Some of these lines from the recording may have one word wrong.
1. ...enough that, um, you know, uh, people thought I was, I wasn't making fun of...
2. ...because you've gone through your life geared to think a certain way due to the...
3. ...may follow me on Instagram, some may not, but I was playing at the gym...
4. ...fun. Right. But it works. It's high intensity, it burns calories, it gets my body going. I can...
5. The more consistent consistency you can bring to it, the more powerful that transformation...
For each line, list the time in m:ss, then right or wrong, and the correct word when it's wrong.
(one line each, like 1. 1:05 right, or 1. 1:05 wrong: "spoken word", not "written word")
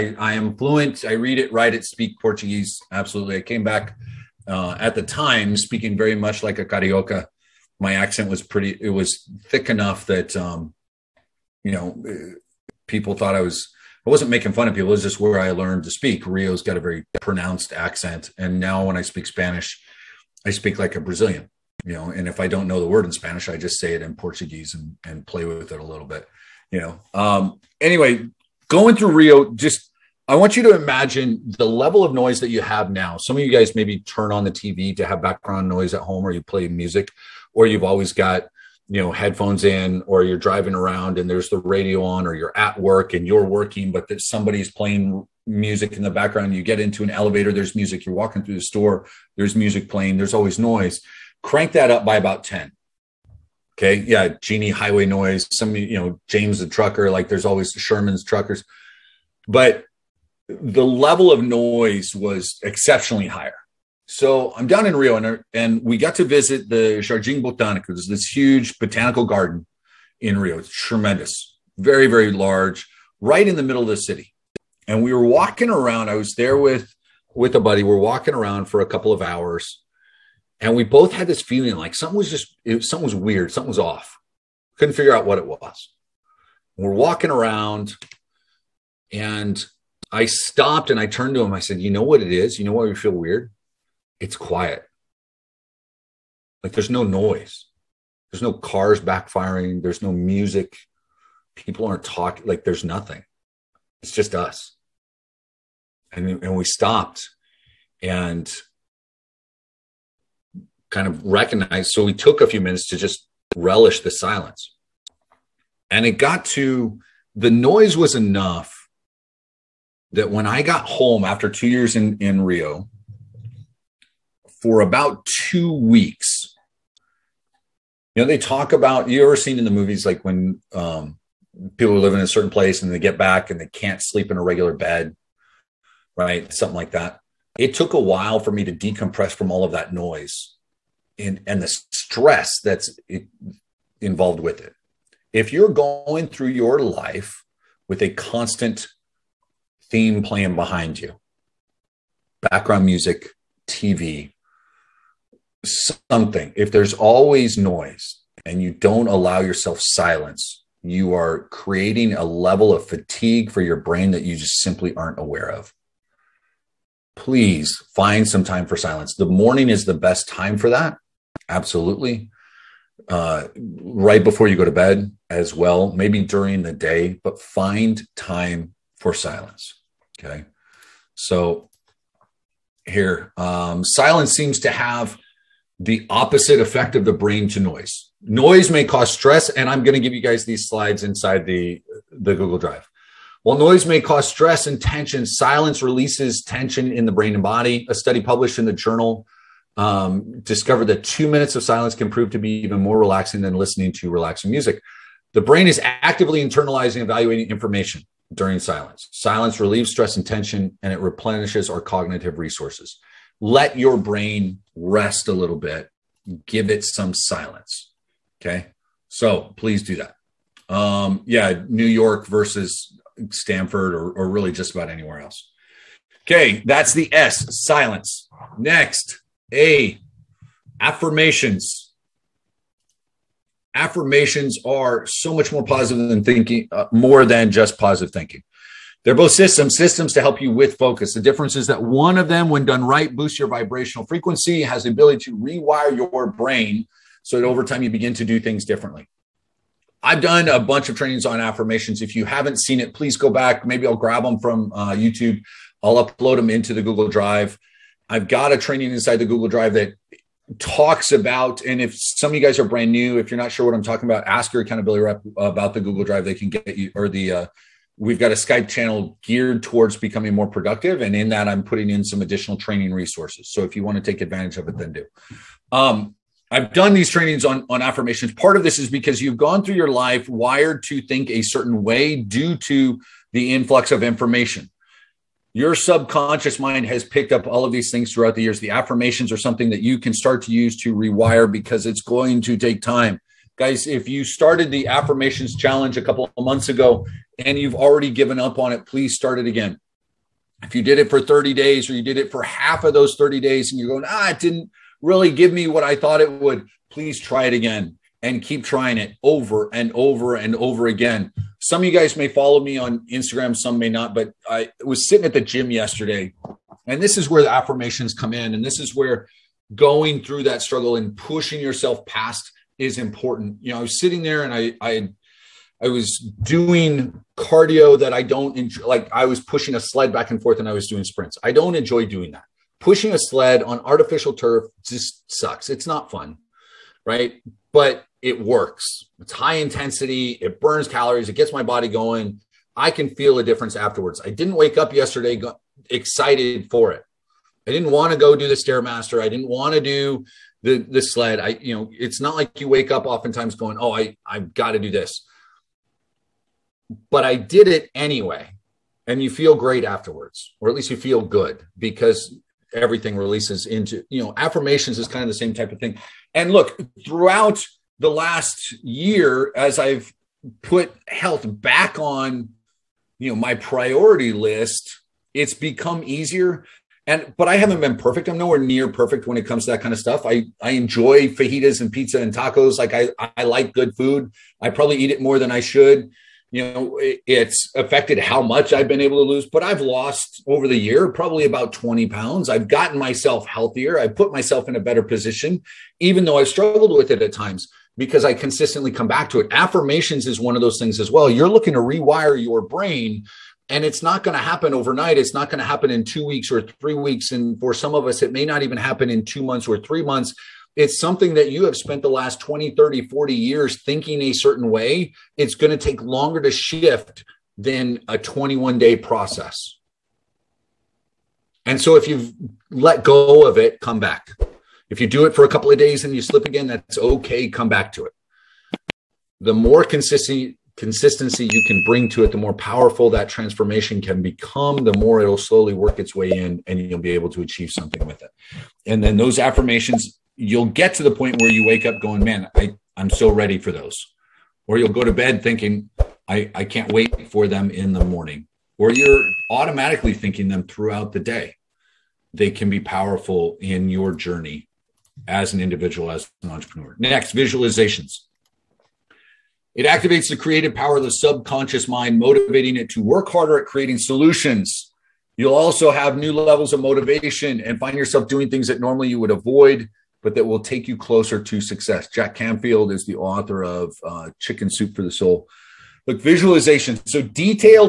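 1. 0:09 right
2. 4:38 wrong: "wired", not "geared"
3. 5:12 wrong: "sitting", not "playing"
4. 5:36 right
5. 7:09 right.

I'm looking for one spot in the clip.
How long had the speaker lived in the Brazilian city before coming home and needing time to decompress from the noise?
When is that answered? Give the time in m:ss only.
2:01.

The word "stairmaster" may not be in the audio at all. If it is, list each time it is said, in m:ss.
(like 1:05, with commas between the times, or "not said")
5:48.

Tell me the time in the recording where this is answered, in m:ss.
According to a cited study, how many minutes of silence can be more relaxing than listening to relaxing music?
3:21.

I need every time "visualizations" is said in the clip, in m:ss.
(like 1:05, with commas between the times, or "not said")
7:37, 7:56.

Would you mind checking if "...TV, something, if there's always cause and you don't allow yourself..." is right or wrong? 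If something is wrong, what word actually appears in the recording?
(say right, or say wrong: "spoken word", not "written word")
wrong: "noise", not "cause".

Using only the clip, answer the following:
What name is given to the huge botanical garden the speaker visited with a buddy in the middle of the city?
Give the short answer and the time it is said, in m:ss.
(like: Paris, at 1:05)
Jardim Botanico, at 1:06.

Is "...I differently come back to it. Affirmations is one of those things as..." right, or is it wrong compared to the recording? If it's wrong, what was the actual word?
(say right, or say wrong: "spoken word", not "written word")
wrong: "consistently", not "differently".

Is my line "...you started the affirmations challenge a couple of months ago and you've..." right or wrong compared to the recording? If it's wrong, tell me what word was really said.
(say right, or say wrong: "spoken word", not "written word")
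right.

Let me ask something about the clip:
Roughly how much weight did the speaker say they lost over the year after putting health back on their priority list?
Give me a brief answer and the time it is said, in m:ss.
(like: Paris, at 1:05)
20 pounds, at 6:31.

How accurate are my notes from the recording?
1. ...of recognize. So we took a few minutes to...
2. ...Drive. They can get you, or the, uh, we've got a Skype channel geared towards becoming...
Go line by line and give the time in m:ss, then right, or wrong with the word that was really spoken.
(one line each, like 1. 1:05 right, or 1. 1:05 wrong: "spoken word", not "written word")
1. 1:51 right
2. 4:26 right.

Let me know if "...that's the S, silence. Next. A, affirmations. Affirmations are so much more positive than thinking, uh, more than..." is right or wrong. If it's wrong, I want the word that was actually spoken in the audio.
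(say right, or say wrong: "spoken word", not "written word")
right.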